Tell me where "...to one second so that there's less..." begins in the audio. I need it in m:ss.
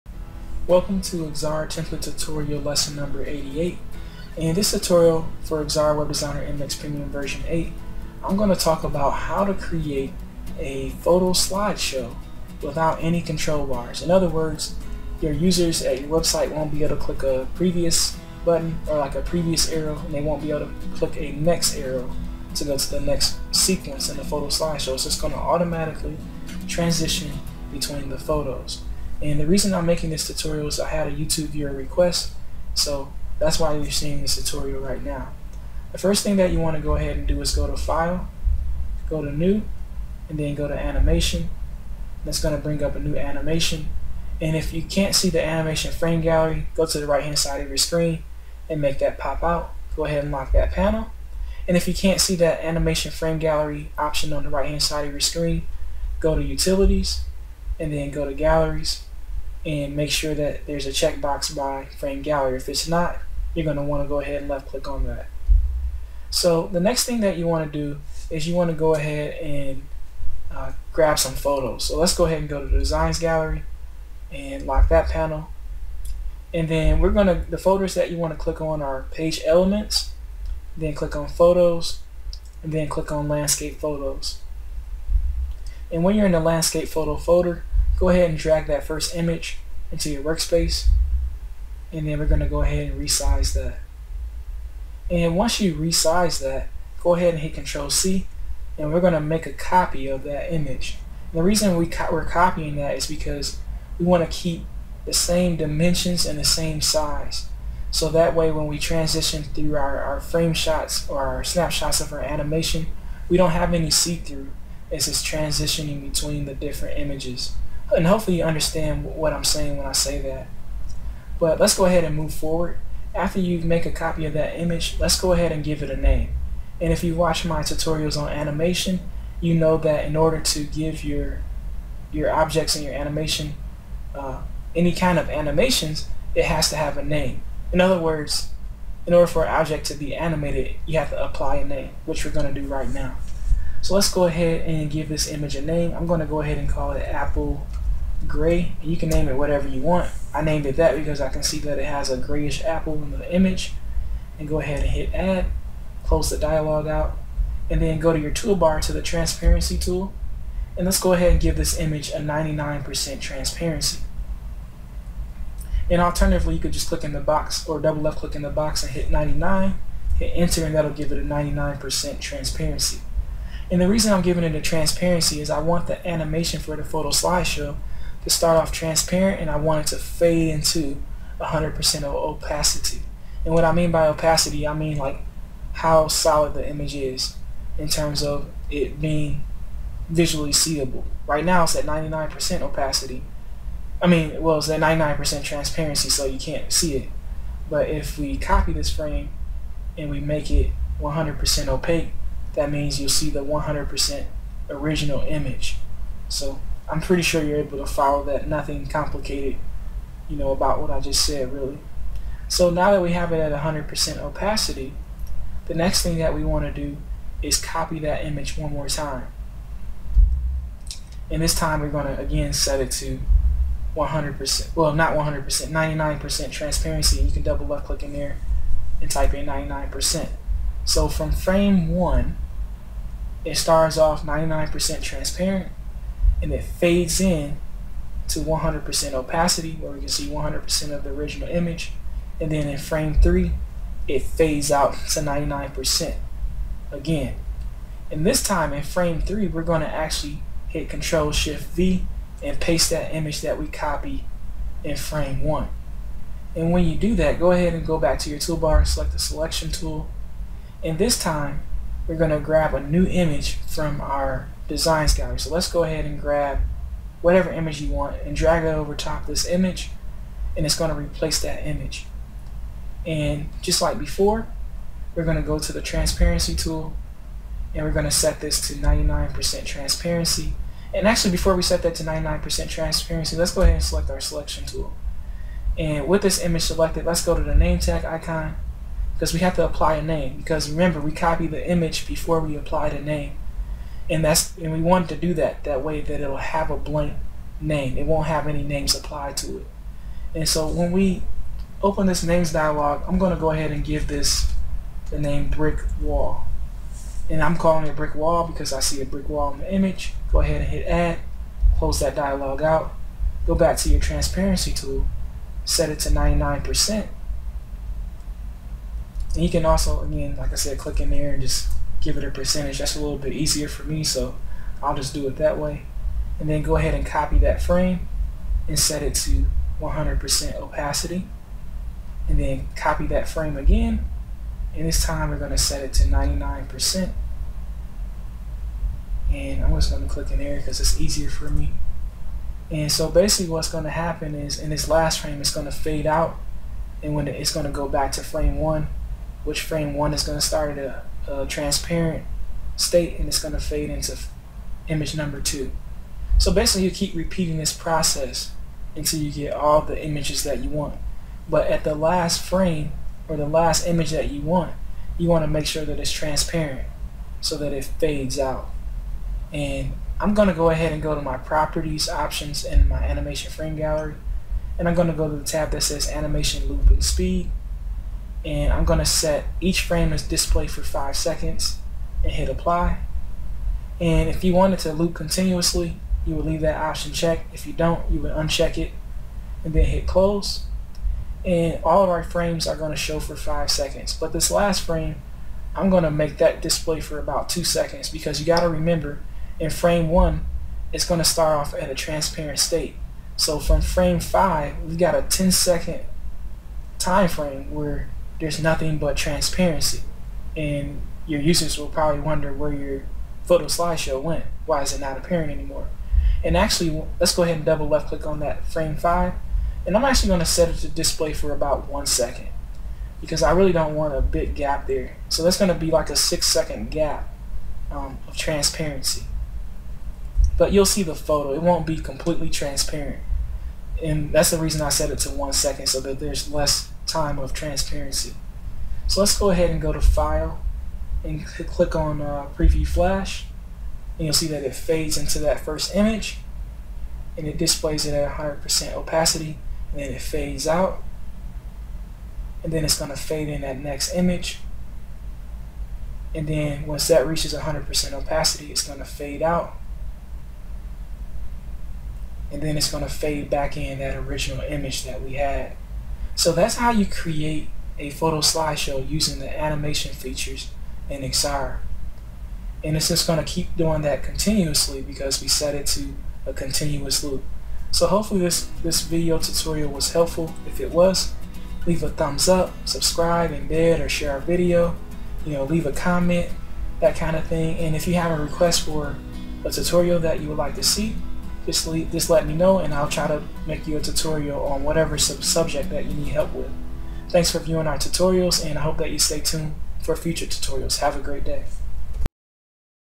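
7:15.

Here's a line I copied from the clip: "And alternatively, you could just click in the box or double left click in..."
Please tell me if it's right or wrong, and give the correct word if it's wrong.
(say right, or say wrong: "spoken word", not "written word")
right.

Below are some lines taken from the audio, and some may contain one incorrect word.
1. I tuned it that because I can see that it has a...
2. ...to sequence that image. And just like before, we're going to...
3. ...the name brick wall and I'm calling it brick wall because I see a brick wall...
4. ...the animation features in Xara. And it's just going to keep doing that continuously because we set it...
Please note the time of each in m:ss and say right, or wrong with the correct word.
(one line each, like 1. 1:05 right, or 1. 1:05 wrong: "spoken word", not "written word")
1. 2:30 wrong: "named", not "tuned"
2. 4:30 wrong: "replace", not "sequence"
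3. 5:05 right
4. 7:49 right.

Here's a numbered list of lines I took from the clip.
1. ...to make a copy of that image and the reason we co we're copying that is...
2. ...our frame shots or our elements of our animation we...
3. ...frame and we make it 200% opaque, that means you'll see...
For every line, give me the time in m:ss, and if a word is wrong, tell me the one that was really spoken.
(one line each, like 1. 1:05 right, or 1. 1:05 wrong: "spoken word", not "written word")
1. 1:39 right
2. 1:50 wrong: "snapshots", not "elements"
3. 3:18 wrong: "100", not "200".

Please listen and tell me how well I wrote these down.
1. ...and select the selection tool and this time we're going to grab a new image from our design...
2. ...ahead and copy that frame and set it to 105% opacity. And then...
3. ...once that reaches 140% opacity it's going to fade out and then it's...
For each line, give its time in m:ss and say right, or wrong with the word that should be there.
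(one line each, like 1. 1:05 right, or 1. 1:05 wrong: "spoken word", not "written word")
1. 4:18 right
2. 5:26 wrong: "100", not "105"
3. 7:36 wrong: "100", not "140".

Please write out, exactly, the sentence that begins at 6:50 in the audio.
And your users will probably wonder where your photo slideshow went.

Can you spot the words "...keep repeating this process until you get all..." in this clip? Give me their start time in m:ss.
5:56.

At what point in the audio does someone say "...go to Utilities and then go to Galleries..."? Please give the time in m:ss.
0:56.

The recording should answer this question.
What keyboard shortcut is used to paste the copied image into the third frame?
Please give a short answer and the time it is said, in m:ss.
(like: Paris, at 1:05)
Control Shift V, at 4:10.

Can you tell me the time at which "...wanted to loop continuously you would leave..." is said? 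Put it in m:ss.
6:24.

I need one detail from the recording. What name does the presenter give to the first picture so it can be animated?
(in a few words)
Apple gray.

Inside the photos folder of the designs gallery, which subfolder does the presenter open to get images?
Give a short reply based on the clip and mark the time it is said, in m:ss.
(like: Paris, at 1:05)
landscape photos, at 1:23.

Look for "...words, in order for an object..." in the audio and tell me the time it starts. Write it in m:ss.
2:17.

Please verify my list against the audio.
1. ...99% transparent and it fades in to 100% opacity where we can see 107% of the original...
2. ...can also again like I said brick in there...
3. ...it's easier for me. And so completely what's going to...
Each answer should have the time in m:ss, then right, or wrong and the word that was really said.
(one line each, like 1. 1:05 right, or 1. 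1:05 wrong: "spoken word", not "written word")
1. 3:54 wrong: "100", not "107"
2. 5:19 wrong: "click", not "brick"
3. 5:40 wrong: "basically", not "completely".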